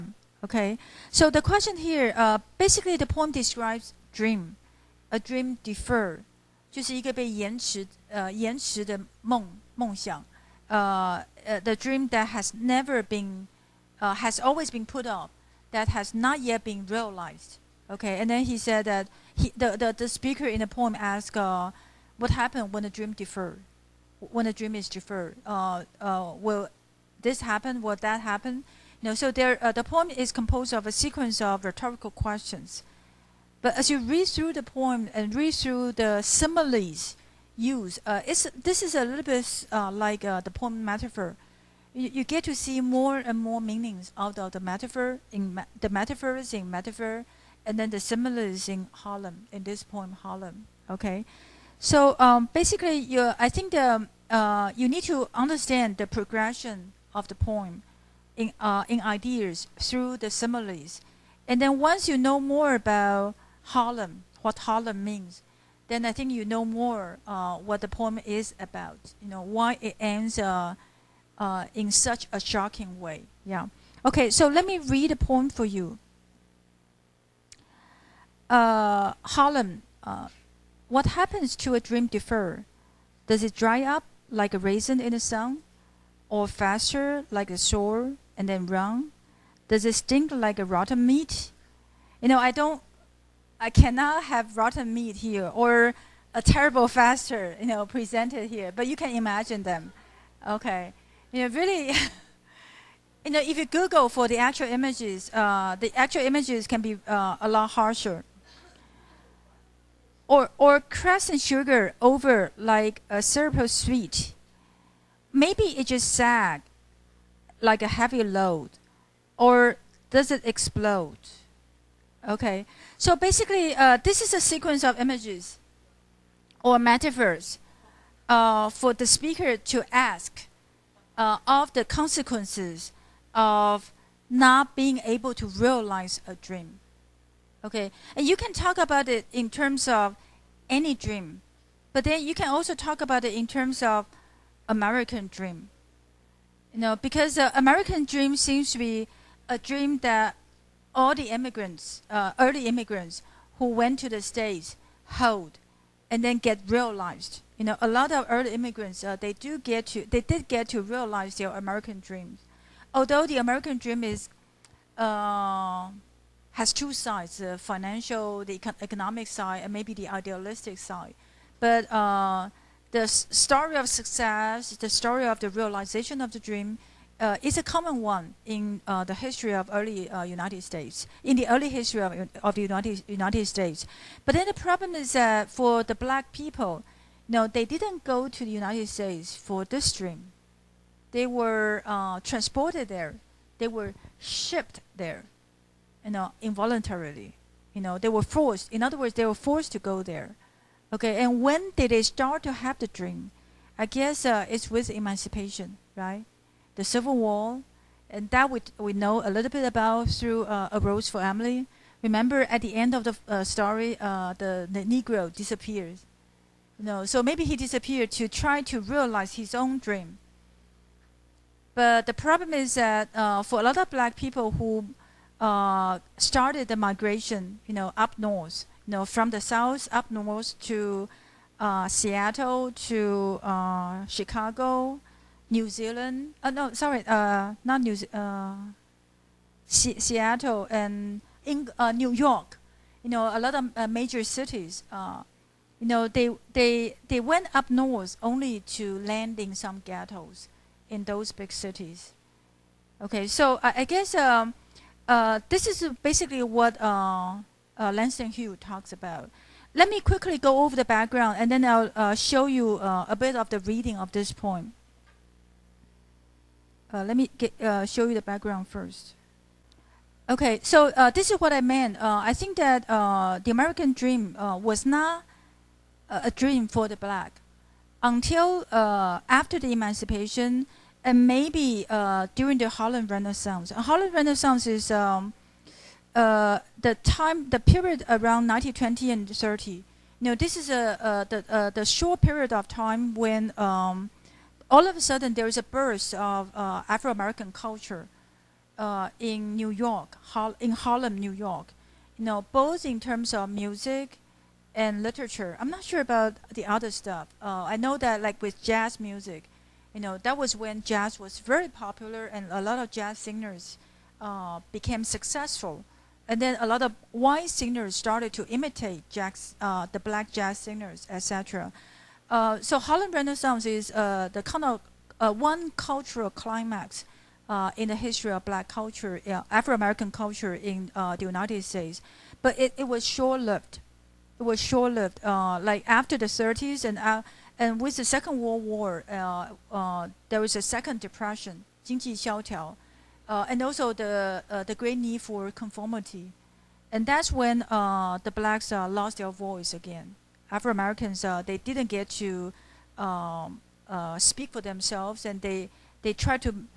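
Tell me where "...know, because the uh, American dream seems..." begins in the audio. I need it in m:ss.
2:26.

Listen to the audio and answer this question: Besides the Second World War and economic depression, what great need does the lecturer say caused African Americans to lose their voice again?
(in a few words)
conformity.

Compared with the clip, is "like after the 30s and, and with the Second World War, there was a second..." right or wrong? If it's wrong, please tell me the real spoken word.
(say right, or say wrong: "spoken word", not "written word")
right.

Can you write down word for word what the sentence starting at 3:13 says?
They were shipped there, you know, involuntarily.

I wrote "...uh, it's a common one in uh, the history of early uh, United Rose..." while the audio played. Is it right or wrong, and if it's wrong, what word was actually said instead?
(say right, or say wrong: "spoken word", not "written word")
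wrong: "States", not "Rose".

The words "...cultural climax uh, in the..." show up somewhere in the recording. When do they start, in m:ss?
5:25.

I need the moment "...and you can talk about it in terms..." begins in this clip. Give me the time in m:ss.
2:18.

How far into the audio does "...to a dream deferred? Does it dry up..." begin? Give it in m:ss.
1:21.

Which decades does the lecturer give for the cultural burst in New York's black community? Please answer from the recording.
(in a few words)
1920 and 30.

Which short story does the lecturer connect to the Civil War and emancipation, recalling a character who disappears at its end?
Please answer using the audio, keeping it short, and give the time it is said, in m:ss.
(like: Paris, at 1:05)
A Rose for Emily, at 3:30.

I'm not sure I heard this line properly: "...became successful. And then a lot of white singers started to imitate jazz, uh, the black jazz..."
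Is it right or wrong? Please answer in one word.
right.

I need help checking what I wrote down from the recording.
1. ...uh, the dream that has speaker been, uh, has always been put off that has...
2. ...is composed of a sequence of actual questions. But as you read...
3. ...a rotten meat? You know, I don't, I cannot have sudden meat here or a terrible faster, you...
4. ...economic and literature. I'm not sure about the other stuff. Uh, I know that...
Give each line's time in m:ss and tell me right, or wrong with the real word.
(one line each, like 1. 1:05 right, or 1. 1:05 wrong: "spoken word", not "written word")
1. 0:06 wrong: "never", not "speaker"
2. 0:30 wrong: "rhetorical", not "actual"
3. 1:30 wrong: "rotten", not "sudden"
4. 5:03 wrong: "music", not "economic".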